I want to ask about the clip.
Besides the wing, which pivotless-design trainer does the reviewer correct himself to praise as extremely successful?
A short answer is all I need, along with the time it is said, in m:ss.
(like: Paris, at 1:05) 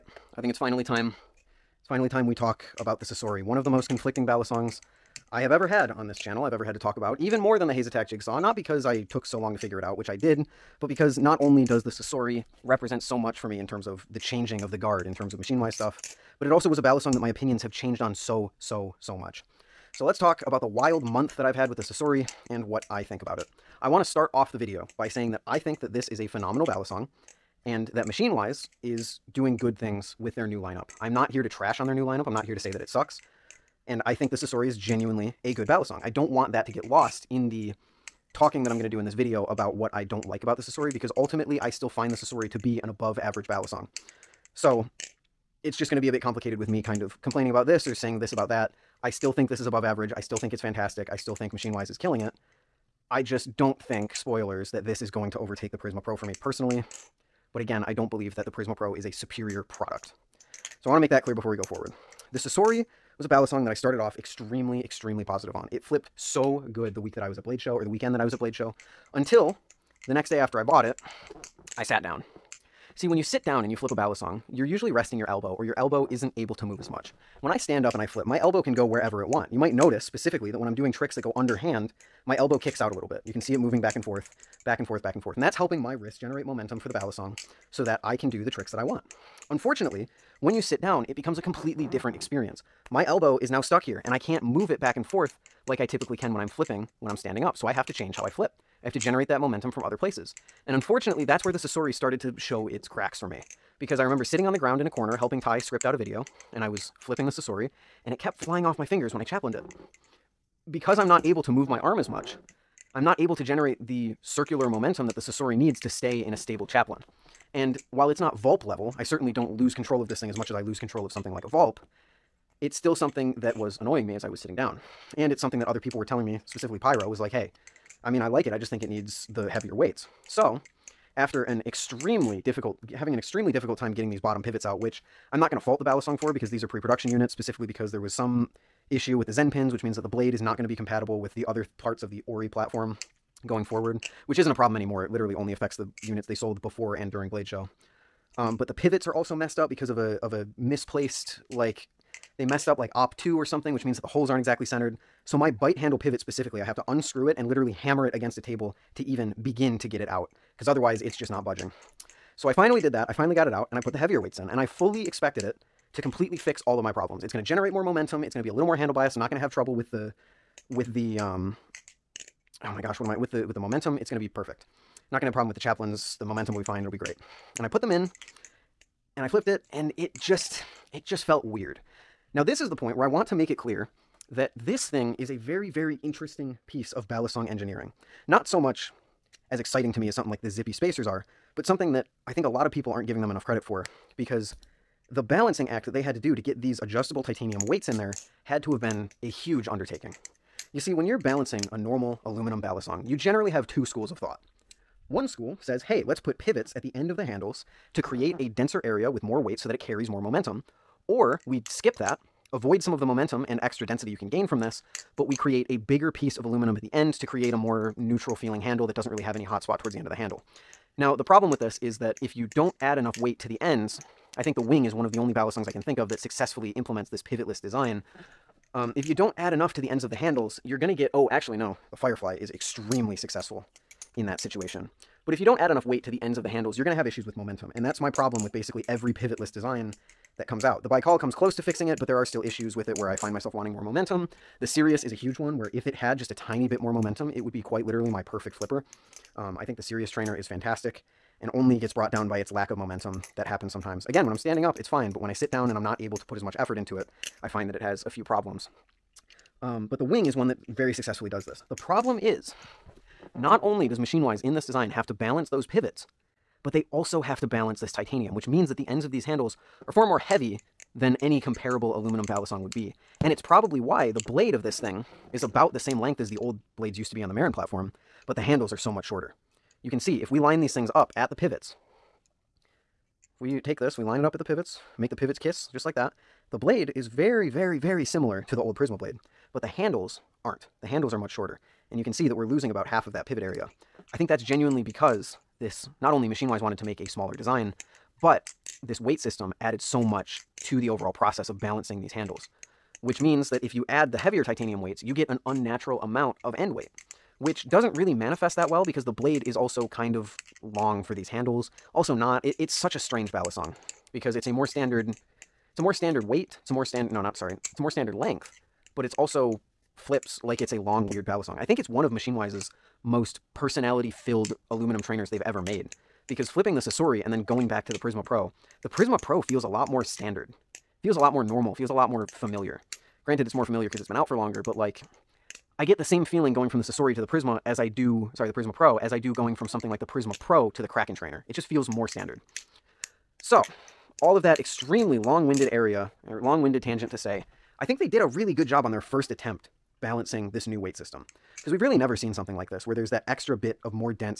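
Firefly, at 3:51.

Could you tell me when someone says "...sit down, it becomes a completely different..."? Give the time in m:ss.
1:30.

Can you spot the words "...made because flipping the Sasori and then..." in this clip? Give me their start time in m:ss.
5:25.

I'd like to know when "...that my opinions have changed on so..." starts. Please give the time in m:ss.
0:17.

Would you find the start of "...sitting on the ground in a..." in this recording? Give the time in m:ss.
1:44.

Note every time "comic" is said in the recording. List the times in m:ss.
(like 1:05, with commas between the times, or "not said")
not said.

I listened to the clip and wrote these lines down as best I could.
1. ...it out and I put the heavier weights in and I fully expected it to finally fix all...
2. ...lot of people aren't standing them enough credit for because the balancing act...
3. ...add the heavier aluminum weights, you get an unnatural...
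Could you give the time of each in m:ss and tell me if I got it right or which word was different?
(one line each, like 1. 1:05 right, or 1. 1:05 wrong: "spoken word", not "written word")
1. 2:43 wrong: "completely", not "finally"
2. 3:12 wrong: "giving", not "standing"
3. 5:03 wrong: "titanium", not "aluminum".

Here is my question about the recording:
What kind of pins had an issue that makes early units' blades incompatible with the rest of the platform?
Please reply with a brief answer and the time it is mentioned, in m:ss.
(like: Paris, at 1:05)
Zen pins, at 2:19.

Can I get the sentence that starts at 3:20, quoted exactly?
You see, when you're balancing a normal aluminum balisong, you generally have two schools of thought.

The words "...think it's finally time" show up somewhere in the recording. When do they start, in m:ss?
0:00.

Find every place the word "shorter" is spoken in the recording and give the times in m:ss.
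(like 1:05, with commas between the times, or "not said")
4:39, 4:51.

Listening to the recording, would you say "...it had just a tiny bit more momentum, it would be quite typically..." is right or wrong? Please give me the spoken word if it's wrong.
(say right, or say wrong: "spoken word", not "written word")
wrong: "literally", not "typically".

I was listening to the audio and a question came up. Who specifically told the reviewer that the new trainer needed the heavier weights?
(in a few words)
Pyro.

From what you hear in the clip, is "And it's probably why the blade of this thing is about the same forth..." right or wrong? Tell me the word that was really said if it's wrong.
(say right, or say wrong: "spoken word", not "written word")
wrong: "length", not "forth".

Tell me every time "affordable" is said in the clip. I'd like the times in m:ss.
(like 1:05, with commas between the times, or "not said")
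not said.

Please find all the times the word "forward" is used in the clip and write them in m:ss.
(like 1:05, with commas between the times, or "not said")
1:01, 2:23.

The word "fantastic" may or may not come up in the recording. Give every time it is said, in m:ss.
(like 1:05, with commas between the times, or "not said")
0:50, 4:10.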